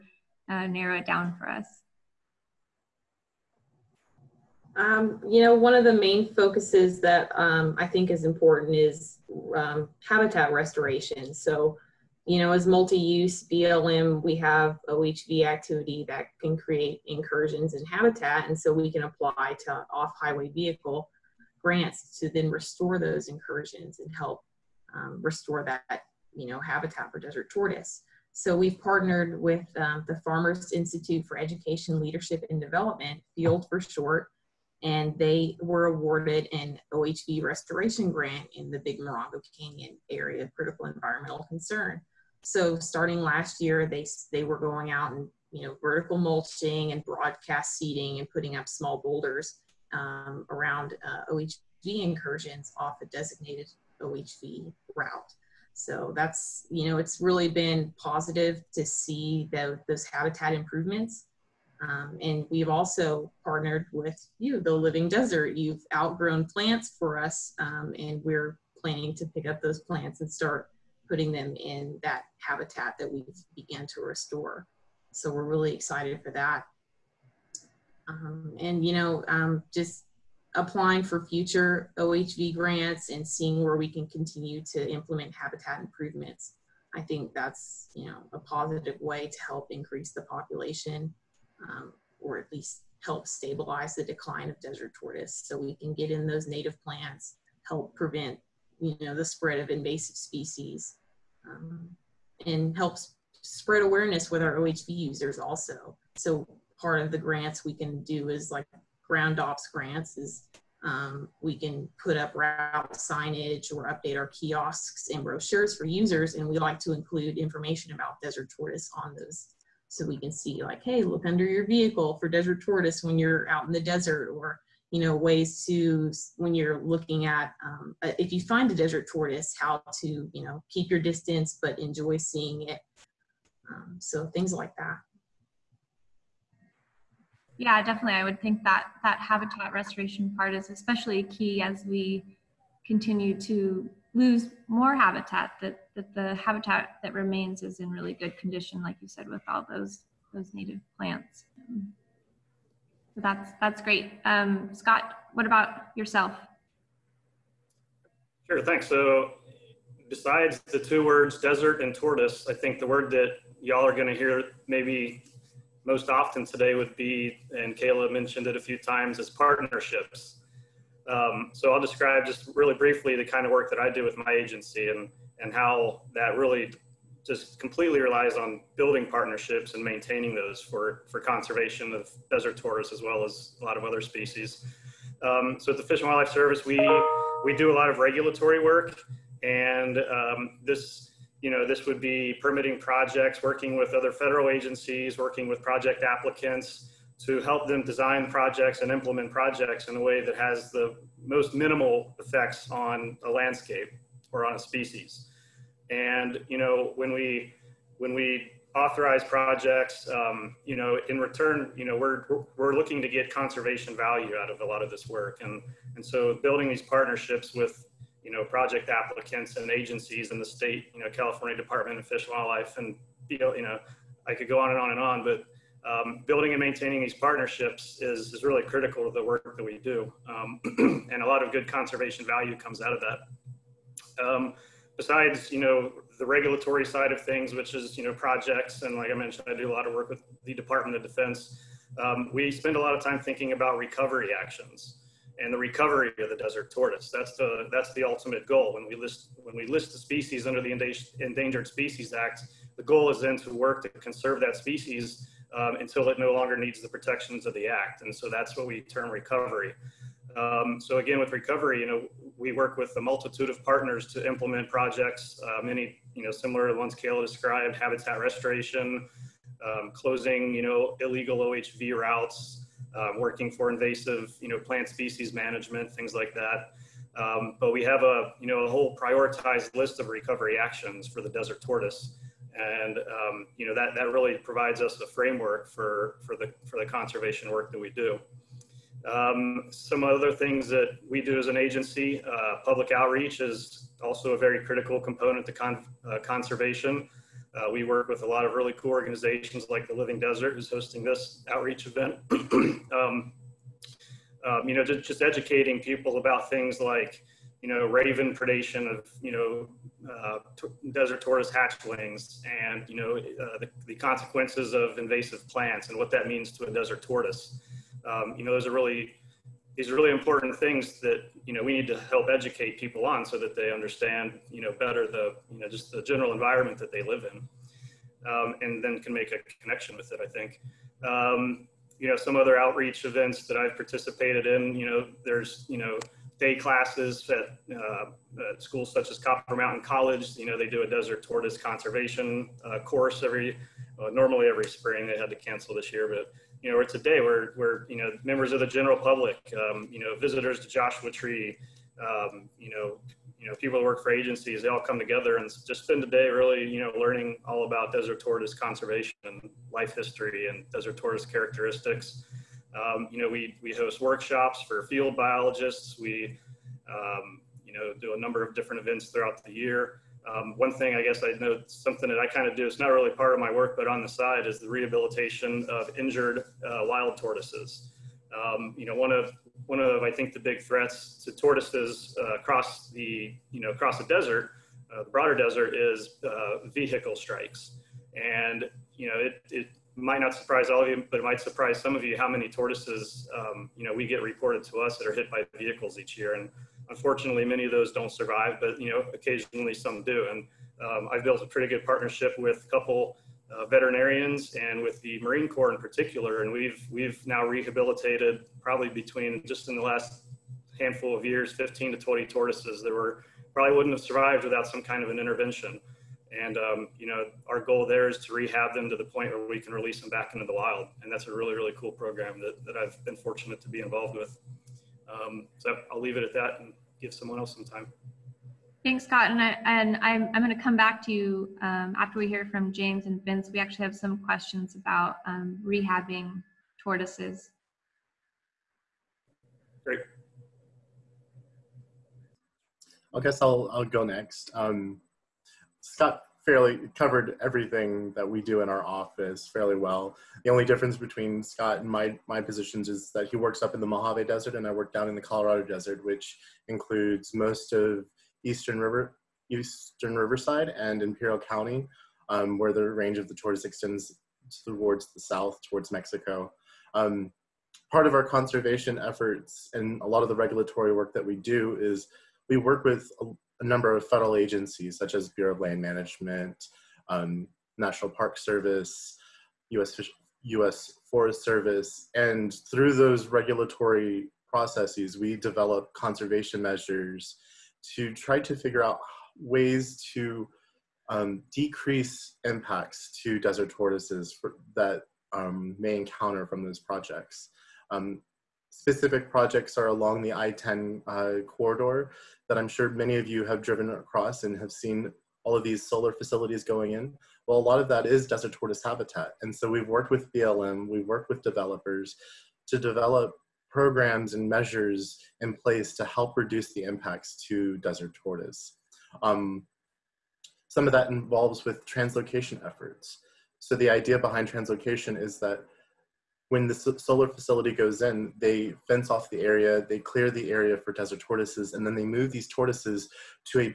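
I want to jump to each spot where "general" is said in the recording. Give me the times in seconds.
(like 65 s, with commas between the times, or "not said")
326 s, 348 s.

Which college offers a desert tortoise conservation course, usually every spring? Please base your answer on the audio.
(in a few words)
Copper Mountain College.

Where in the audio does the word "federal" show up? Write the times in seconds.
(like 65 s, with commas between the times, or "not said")
194 s, 474 s.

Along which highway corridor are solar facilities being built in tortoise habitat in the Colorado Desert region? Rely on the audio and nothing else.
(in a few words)
I-10.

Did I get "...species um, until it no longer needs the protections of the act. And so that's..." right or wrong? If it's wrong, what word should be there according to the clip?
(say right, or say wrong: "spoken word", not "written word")
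right.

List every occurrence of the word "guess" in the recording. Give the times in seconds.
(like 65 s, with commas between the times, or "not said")
371 s, 443 s.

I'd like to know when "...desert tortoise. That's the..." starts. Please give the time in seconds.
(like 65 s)
246 s.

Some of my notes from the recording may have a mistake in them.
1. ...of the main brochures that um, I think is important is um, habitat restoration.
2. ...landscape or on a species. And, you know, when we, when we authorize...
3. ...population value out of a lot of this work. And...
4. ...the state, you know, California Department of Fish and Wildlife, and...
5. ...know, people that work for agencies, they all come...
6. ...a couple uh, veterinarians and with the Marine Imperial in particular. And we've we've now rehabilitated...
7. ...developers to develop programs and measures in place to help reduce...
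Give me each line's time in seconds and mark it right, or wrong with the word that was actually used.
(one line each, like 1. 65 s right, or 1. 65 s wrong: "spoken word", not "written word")
1. 5 s wrong: "focuses", not "brochures"
2. 203 s right
3. 213 s wrong: "conservation", not "population"
4. 220 s right
5. 353 s right
6. 402 s wrong: "Corps", not "Imperial"
7. 511 s right.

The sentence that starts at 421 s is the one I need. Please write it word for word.
And that's a really, really cool program that, that I've been fortunate to be involved with.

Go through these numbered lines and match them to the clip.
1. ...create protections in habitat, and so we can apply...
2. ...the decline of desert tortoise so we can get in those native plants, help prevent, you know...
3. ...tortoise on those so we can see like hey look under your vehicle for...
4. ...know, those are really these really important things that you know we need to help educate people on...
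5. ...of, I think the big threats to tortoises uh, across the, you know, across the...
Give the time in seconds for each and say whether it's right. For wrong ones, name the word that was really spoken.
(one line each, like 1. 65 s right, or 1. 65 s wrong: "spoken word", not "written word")
1. 16 s wrong: "incursions", not "protections"
2. 93 s right
3. 118 s right
4. 318 s right
5. 379 s right.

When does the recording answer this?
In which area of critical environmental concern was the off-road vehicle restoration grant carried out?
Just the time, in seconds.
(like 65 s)
38 s.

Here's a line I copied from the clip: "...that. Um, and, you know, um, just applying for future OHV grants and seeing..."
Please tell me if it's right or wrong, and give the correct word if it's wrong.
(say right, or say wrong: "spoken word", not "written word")
right.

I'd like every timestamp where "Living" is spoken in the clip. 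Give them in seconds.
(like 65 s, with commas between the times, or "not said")
64 s, 299 s.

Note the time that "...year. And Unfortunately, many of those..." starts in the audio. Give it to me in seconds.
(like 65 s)
396 s.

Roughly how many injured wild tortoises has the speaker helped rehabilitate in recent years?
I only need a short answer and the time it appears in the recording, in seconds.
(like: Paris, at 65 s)
15 to 20, at 411 s.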